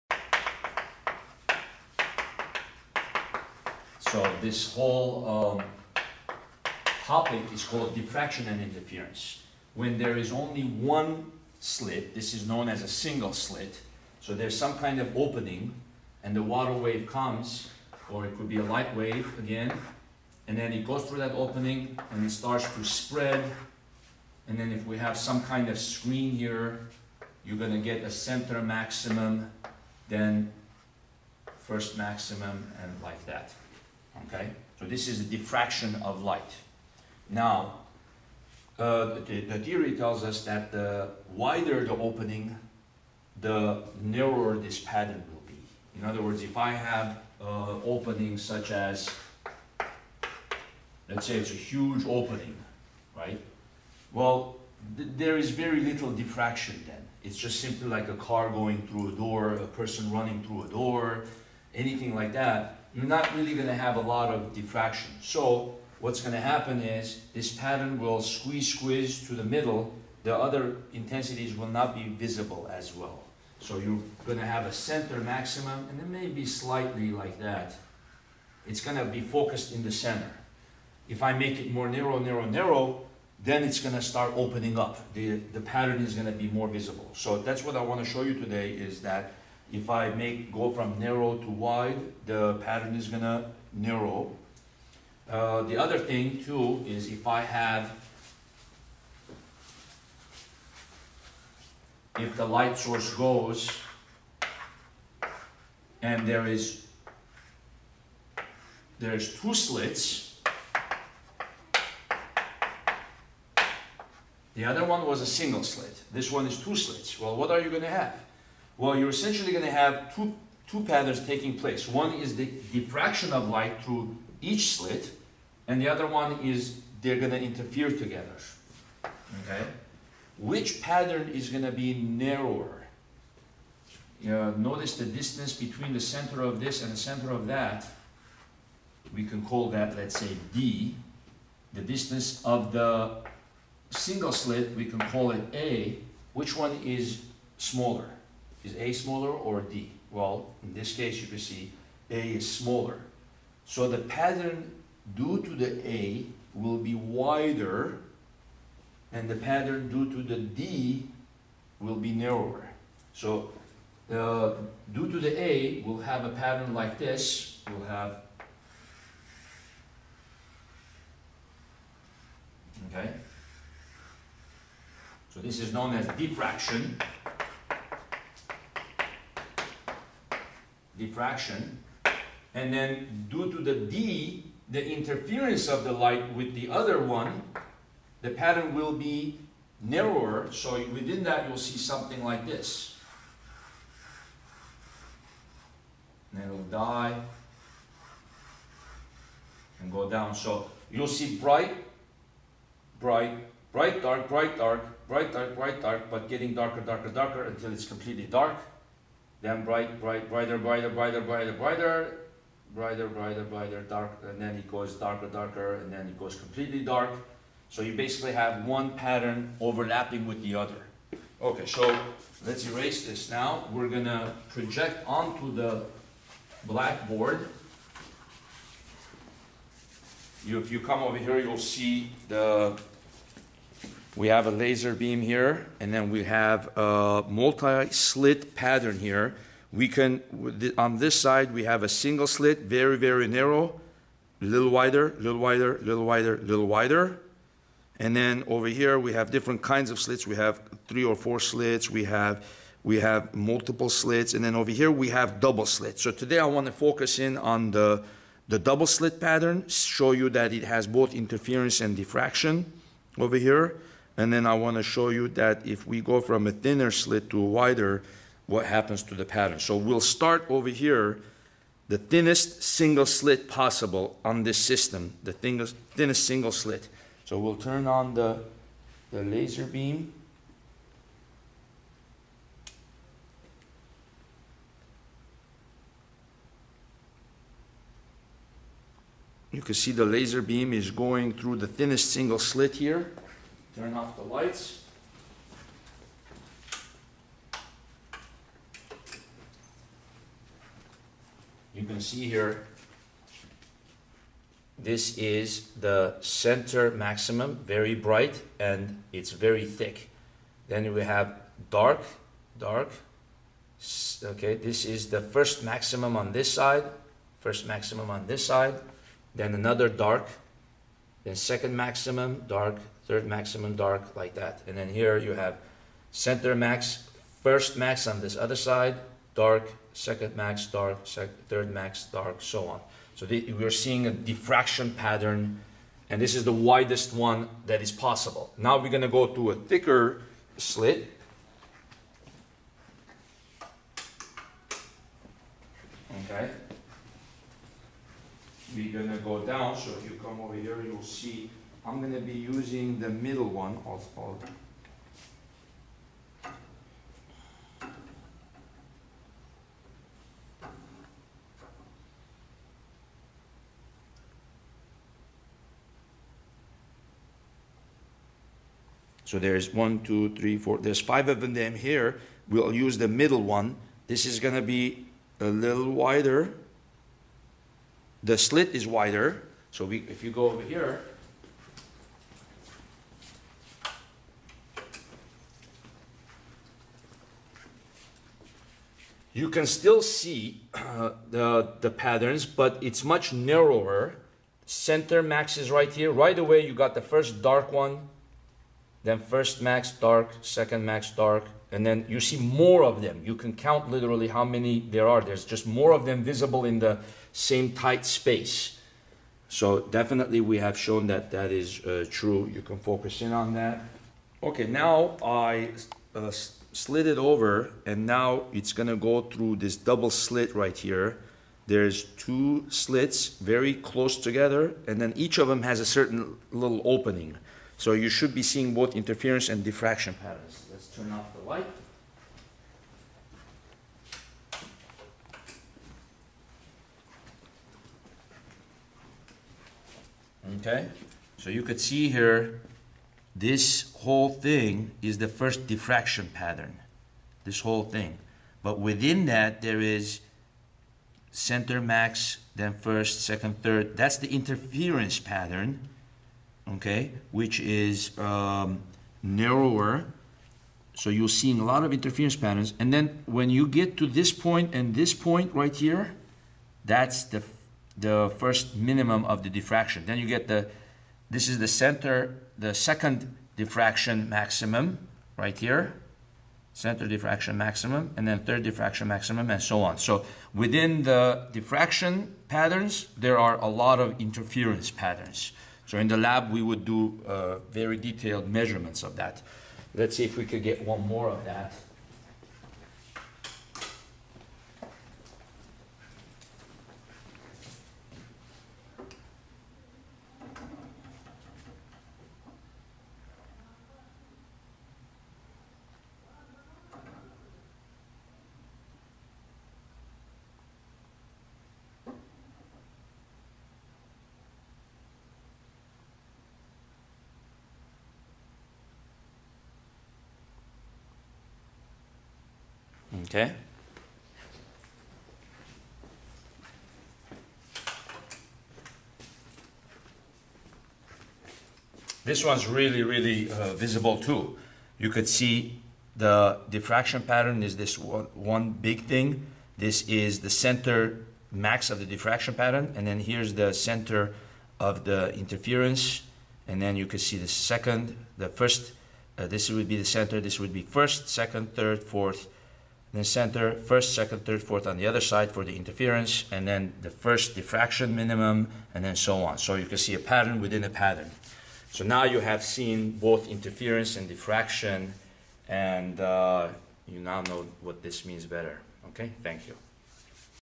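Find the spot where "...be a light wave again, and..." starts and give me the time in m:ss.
0:18.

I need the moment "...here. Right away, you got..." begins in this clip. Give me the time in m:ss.
6:35.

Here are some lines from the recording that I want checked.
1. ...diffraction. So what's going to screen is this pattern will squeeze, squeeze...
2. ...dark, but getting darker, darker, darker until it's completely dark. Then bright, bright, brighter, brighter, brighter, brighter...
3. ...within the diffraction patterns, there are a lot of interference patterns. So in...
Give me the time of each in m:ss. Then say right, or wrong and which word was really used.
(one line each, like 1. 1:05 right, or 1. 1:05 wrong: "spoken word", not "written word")
1. 1:04 wrong: "happen", not "screen"
2. 3:25 right
3. 8:00 right.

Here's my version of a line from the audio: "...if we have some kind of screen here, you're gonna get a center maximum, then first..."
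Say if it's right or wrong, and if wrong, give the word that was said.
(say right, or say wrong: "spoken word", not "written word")
right.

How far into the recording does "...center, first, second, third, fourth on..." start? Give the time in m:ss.
9:13.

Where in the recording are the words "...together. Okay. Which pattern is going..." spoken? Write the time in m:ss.
2:07.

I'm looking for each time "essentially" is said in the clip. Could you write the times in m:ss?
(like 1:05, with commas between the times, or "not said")
1:59.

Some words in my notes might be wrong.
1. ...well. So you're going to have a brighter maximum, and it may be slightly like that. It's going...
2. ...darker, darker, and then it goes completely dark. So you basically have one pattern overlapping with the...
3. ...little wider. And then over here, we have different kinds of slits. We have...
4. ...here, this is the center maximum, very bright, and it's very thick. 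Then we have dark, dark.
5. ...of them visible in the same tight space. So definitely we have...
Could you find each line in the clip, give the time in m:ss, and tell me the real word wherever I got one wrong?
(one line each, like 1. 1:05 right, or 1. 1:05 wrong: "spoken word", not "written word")
1. 1:12 wrong: "center", not "brighter"
2. 3:34 right
3. 4:06 right
4. 5:02 right
5. 6:45 right.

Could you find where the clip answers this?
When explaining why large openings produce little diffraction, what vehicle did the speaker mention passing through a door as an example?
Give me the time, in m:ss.
0:58.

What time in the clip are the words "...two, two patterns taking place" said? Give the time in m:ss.
2:00.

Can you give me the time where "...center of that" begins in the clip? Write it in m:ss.
2:16.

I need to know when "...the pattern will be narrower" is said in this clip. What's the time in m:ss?
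3:08.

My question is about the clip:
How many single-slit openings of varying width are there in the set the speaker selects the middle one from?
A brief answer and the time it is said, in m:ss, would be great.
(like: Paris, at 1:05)
5, at 6:10.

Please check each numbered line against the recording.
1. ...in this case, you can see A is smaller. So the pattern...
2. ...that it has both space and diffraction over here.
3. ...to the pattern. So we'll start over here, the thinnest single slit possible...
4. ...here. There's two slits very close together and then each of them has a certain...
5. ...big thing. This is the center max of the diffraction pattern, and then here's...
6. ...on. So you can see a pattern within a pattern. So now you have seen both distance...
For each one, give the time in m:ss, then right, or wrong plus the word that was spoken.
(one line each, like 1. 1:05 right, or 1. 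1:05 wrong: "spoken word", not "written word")
1. 2:30 right
2. 4:20 wrong: "interference", not "space"
3. 4:29 right
4. 7:00 right
5. 8:58 right
6. 9:19 wrong: "interference", not "distance".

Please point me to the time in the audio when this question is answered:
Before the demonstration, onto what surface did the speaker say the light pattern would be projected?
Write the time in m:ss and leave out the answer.
3:45.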